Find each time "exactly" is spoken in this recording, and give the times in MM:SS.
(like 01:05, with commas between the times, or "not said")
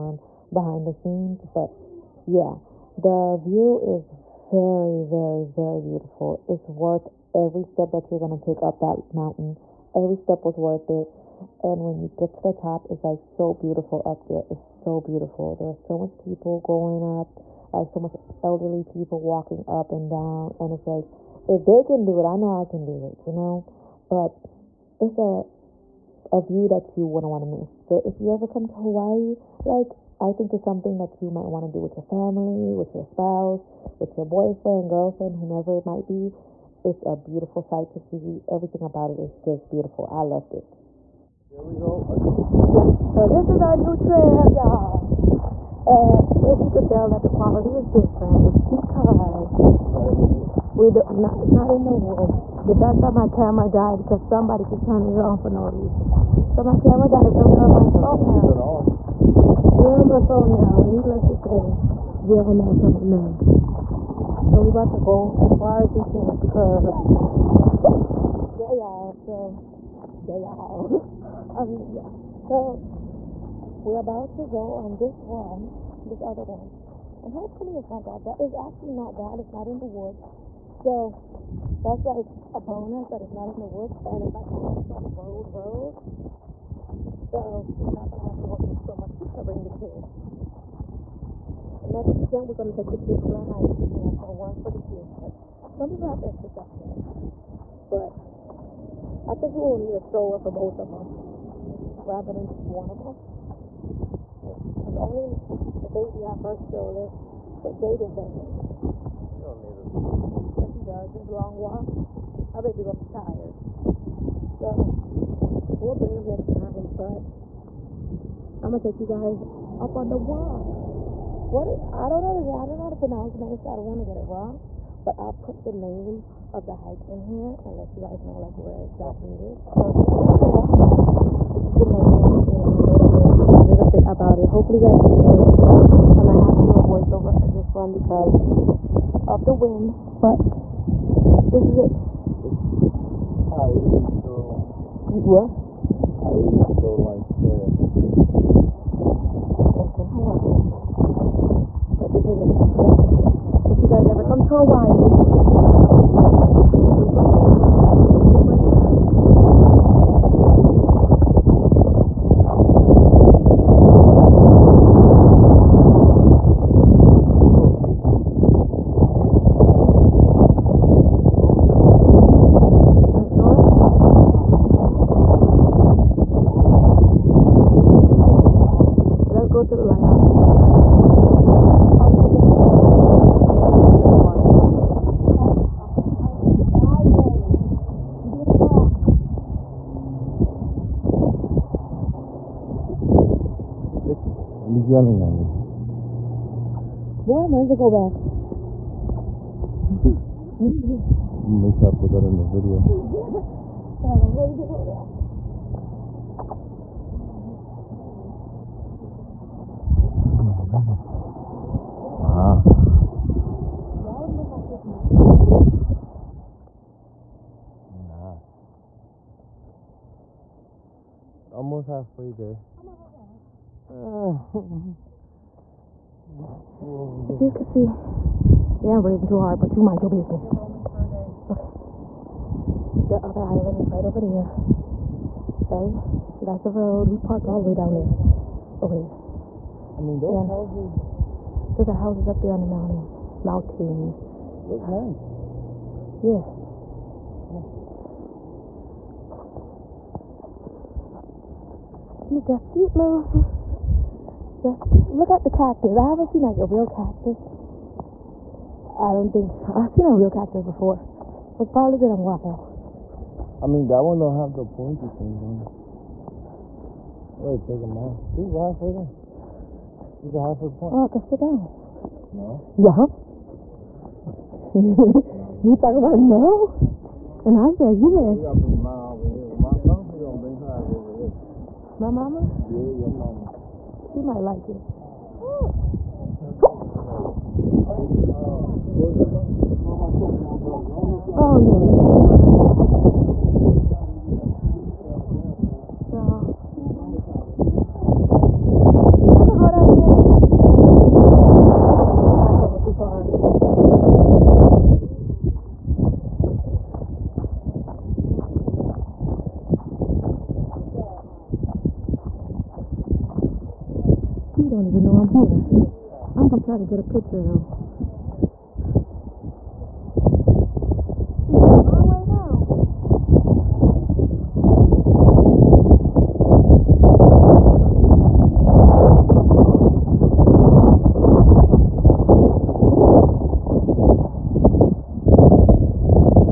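02:08.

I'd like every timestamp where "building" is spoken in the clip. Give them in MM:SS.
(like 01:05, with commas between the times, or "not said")
not said.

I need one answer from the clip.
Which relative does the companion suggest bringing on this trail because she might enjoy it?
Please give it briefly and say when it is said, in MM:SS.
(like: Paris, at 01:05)
Your mama, at 04:42.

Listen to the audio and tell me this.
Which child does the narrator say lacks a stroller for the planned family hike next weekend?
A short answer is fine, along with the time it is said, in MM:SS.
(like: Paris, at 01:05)
Jaden, at 01:47.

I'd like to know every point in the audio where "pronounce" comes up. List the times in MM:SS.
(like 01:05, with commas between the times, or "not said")
02:02.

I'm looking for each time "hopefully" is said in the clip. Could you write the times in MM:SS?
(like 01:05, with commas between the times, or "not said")
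01:17, 02:14.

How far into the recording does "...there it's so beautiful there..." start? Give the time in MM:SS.
00:14.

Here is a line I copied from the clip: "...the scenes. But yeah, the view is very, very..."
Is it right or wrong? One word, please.
right.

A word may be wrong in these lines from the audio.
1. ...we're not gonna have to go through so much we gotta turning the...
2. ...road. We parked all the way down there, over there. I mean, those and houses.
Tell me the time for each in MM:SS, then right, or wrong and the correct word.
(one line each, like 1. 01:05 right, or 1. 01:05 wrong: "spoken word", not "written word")
1. 01:27 wrong: "bring", not "turning"
2. 03:56 right.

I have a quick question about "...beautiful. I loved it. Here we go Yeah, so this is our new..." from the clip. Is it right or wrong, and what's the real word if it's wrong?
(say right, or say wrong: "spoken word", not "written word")
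right.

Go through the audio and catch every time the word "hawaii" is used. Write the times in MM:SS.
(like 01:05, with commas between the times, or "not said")
00:28, 02:34.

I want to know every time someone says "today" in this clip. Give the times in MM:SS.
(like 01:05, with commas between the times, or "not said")
02:02.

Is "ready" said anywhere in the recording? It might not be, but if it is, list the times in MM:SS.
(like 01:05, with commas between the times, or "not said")
03:17, 03:24.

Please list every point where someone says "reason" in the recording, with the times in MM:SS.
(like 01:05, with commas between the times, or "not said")
00:55.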